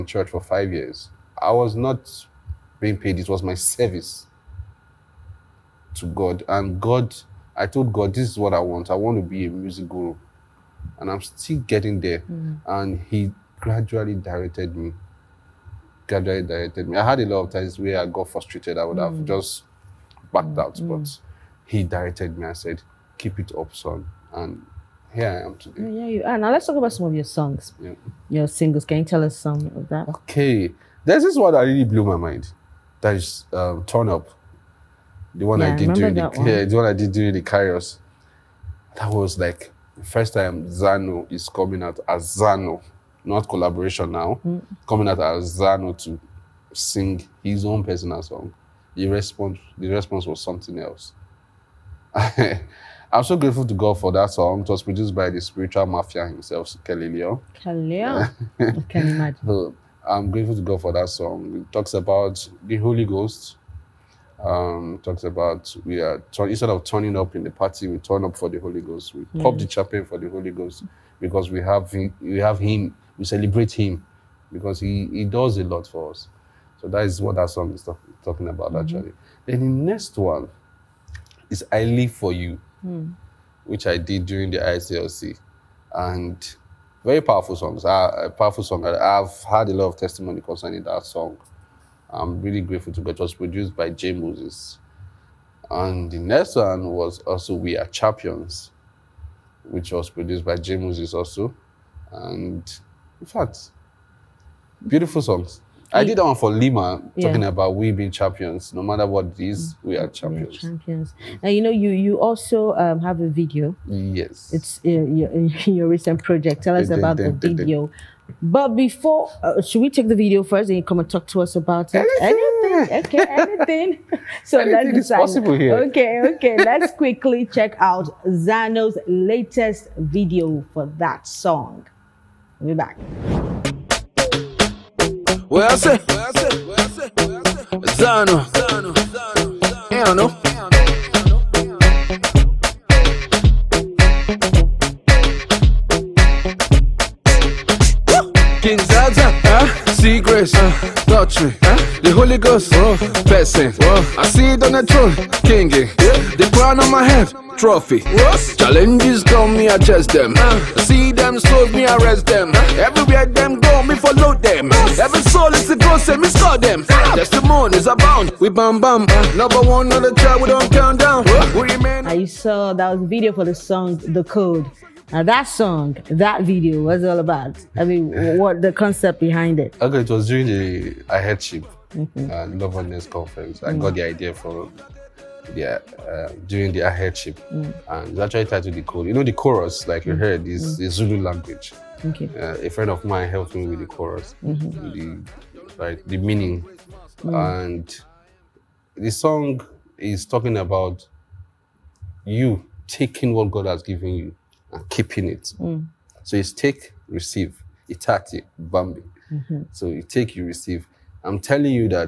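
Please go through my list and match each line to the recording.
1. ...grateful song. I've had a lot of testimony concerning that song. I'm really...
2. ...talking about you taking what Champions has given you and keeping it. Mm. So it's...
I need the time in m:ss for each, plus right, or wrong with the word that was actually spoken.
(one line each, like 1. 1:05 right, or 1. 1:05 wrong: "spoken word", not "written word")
1. 1:28 wrong: "powerful", not "grateful"
2. 3:20 wrong: "God", not "Champions".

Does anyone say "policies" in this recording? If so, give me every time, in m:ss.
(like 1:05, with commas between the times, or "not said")
not said.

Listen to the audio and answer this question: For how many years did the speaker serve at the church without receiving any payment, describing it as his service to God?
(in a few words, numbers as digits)
5 years.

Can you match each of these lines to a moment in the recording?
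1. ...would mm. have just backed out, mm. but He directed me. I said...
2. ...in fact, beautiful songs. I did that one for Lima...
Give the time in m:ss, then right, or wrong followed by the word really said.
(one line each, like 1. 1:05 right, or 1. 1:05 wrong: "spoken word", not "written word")
1. 0:18 right
2. 1:43 right.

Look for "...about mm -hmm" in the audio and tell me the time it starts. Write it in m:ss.
1:18.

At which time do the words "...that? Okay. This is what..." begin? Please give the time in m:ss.
0:29.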